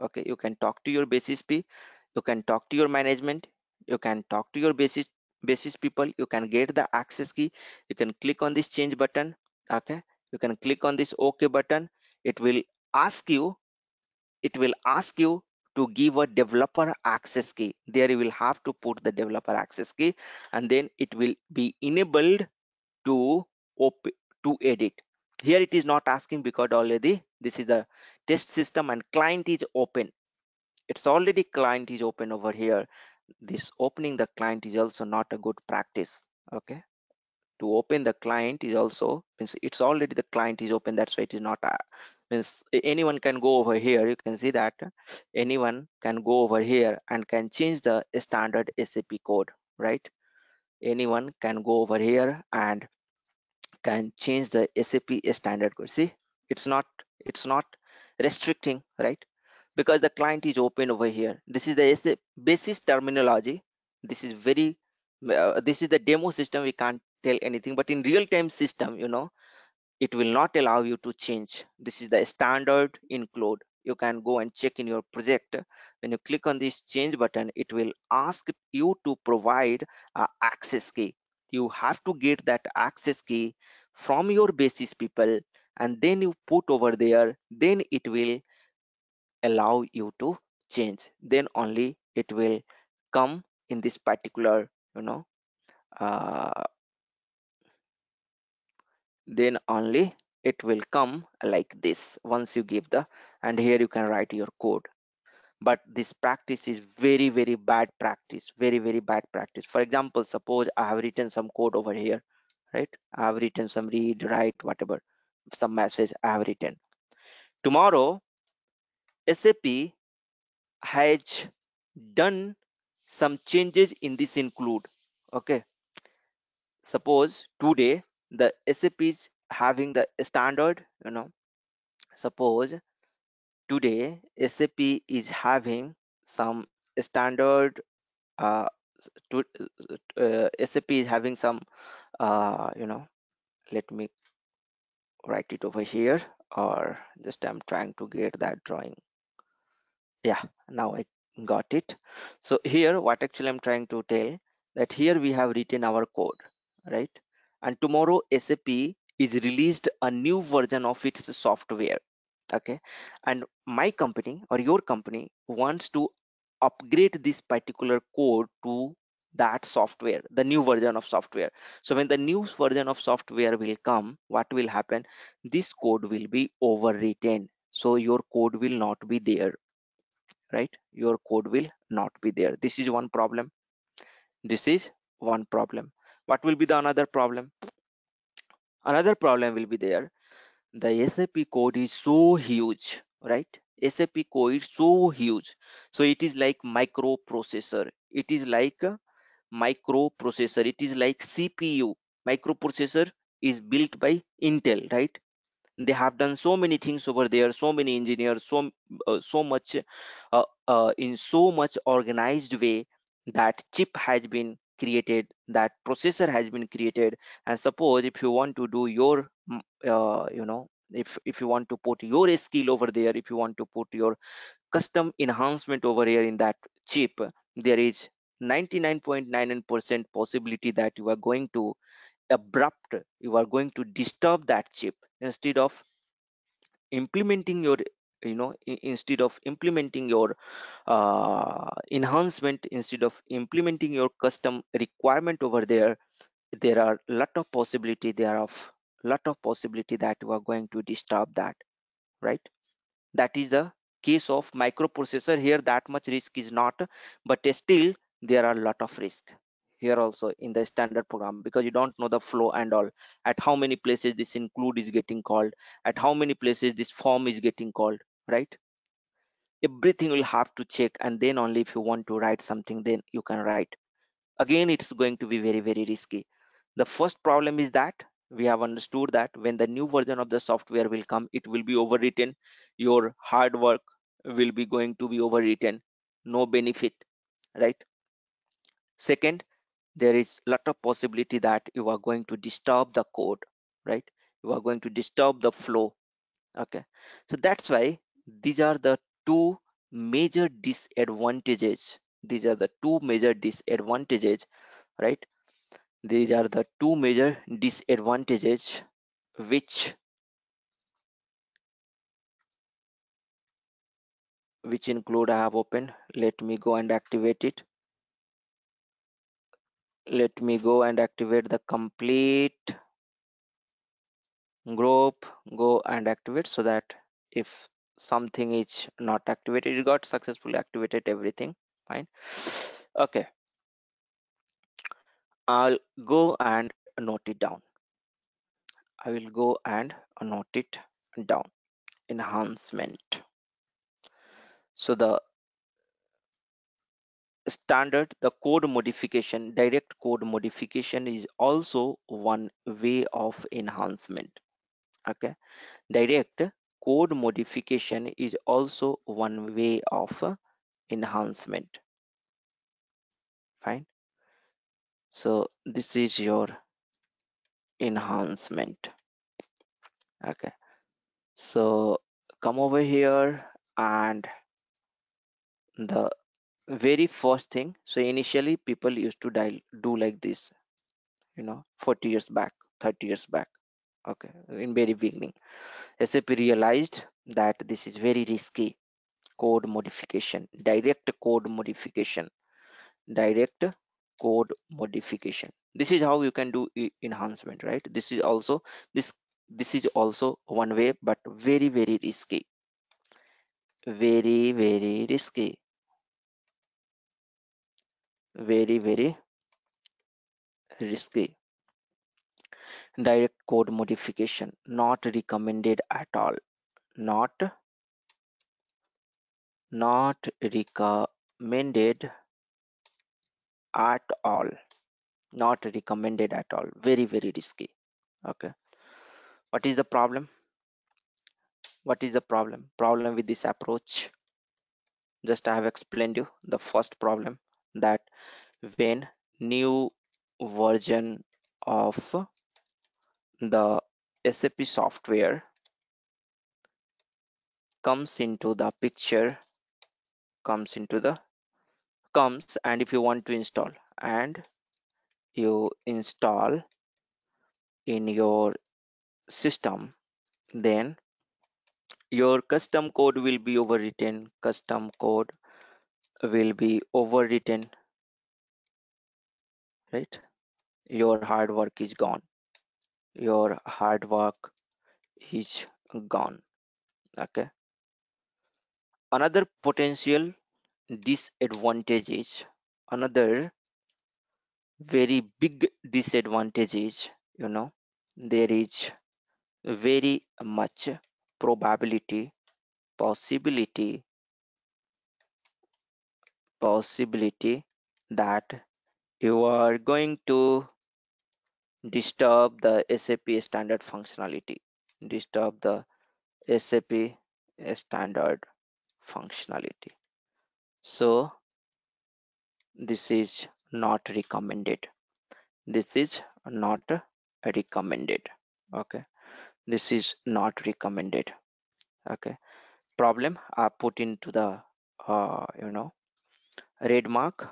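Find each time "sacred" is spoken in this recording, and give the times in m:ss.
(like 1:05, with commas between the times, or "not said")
not said.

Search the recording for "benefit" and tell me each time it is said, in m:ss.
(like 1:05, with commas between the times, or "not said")
4:46.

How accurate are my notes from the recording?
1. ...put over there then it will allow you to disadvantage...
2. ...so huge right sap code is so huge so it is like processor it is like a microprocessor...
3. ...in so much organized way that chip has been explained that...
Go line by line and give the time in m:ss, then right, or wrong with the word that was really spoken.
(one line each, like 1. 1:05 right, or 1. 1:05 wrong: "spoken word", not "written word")
1. 1:26 wrong: "change", not "disadvantage"
2. 3:12 wrong: "microprocessor", not "processor"
3. 3:31 wrong: "created", not "explained".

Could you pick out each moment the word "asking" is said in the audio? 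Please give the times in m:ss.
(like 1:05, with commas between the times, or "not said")
0:26.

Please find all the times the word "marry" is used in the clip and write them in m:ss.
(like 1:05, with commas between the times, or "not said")
not said.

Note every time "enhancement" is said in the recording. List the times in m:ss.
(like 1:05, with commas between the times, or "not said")
3:45, 4:01, 5:42, 5:53, 6:00, 6:07, 6:37.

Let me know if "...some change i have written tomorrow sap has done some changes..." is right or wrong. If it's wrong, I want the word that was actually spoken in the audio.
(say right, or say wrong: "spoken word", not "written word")
wrong: "message", not "change".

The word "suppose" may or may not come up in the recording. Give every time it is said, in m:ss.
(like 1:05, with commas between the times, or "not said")
1:50, 2:06, 2:12, 3:37.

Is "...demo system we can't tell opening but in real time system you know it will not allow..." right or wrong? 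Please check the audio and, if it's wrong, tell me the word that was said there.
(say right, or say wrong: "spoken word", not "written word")
wrong: "anything", not "opening".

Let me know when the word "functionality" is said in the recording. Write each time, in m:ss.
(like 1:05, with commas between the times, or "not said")
8:23, 8:29.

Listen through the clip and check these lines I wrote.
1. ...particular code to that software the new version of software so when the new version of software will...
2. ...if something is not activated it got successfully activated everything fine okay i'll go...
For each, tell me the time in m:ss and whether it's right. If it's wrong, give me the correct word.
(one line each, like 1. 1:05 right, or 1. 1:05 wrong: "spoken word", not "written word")
1. 2:47 right
2. 5:27 right.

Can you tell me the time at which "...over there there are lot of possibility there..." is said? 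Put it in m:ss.
4:05.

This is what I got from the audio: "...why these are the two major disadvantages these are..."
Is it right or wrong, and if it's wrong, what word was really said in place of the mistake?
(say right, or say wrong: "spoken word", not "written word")
right.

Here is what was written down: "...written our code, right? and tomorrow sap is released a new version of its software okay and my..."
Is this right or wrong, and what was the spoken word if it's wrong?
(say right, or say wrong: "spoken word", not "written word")
right.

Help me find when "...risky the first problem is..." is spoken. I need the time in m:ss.
4:35.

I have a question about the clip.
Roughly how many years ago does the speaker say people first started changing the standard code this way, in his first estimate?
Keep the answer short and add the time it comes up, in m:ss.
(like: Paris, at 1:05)
40 years, at 6:21.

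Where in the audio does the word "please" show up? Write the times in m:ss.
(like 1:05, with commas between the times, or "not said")
not said.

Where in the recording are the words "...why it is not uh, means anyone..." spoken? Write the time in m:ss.
0:41.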